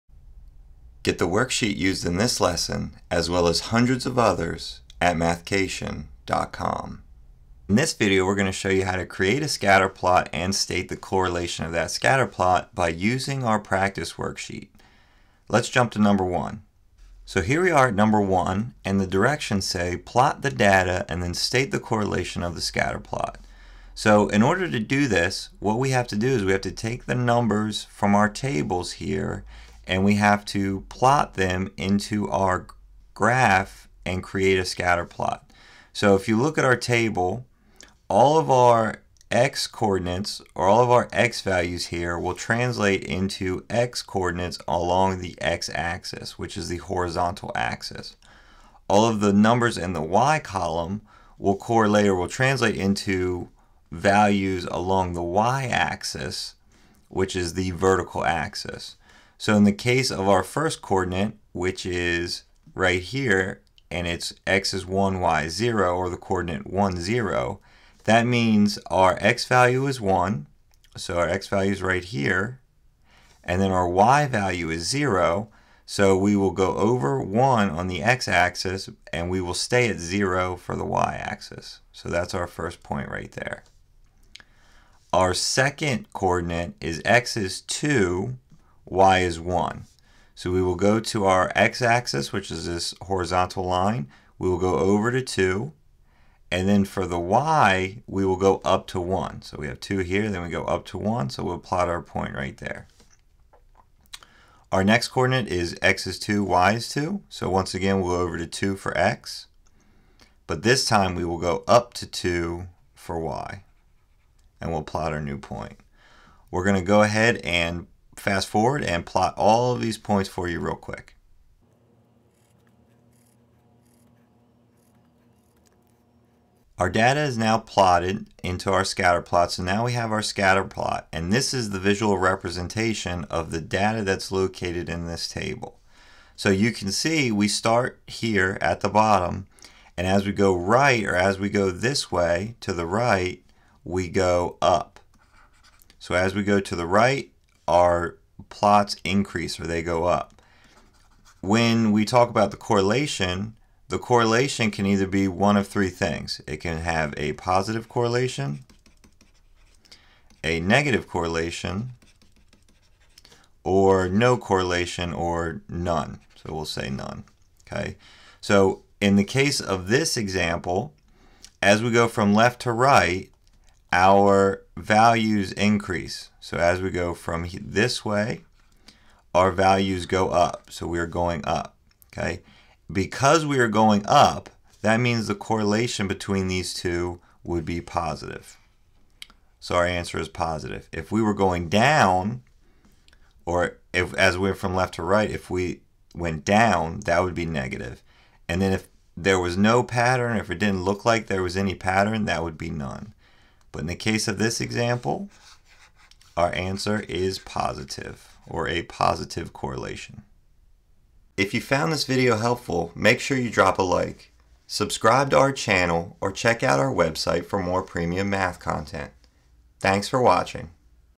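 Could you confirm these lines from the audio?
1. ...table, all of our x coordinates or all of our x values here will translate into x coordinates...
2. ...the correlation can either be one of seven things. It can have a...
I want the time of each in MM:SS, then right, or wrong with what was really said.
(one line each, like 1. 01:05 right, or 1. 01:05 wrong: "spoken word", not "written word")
1. 00:36 right
2. 02:33 wrong: "three", not "seven".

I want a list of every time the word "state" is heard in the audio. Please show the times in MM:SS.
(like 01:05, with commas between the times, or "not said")
00:10, 00:21.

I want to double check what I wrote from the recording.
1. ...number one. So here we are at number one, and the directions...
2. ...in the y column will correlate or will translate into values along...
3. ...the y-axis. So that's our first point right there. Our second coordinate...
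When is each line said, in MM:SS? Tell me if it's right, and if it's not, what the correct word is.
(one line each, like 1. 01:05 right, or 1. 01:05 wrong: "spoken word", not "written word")
1. 00:15 right
2. 00:49 right
3. 01:20 right.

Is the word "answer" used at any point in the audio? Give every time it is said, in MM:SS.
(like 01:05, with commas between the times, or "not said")
03:09, 03:26.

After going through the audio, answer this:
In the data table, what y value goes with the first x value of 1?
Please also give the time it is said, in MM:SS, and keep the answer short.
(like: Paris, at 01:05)
0, at 01:05.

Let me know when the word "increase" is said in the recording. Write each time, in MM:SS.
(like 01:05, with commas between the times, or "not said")
02:29, 02:55.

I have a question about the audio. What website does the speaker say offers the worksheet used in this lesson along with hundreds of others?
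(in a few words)
mathcation.com.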